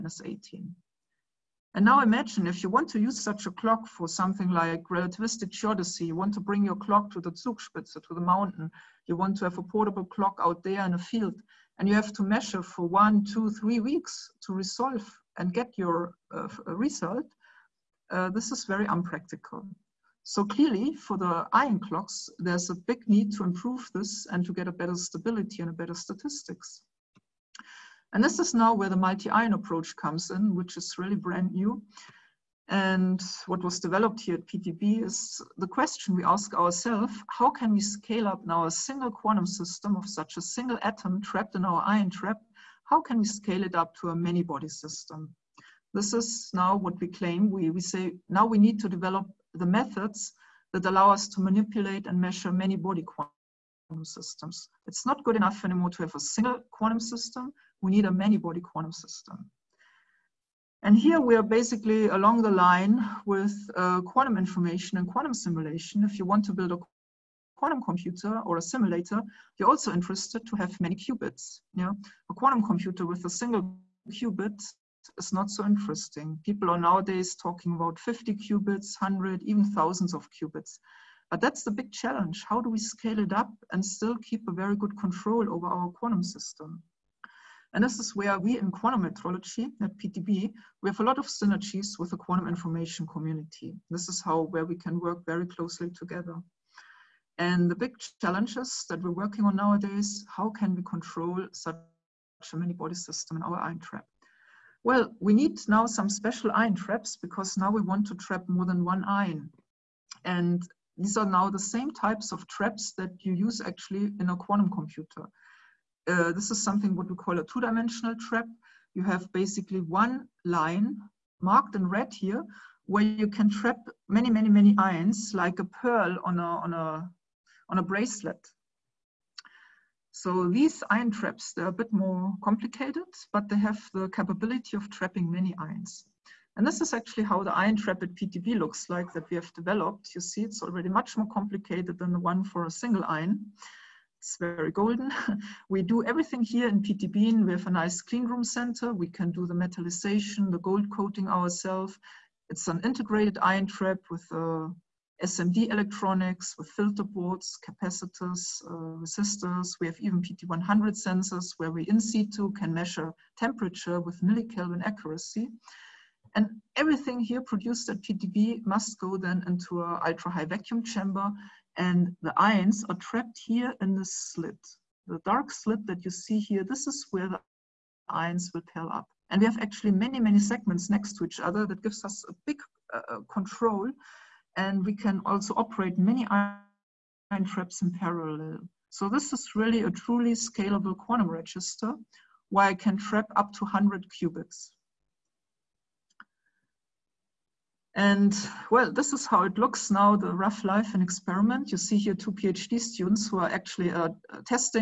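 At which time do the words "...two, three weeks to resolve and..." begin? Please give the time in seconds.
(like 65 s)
13 s.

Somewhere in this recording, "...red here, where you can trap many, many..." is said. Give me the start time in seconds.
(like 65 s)
121 s.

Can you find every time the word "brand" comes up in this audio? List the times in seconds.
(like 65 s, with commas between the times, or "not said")
31 s.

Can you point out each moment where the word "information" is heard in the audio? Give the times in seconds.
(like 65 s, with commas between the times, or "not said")
64 s, 92 s.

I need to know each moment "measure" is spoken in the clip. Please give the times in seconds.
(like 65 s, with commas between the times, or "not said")
12 s, 52 s, 162 s.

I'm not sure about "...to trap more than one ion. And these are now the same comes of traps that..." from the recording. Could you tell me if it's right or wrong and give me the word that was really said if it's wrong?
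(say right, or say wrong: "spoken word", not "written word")
wrong: "types", not "comes".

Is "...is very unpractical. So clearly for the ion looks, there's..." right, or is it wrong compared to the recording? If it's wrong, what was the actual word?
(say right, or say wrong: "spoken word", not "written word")
wrong: "clocks", not "looks".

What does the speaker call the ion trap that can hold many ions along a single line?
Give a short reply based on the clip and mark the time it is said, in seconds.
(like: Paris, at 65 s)
two-dimensional trap, at 117 s.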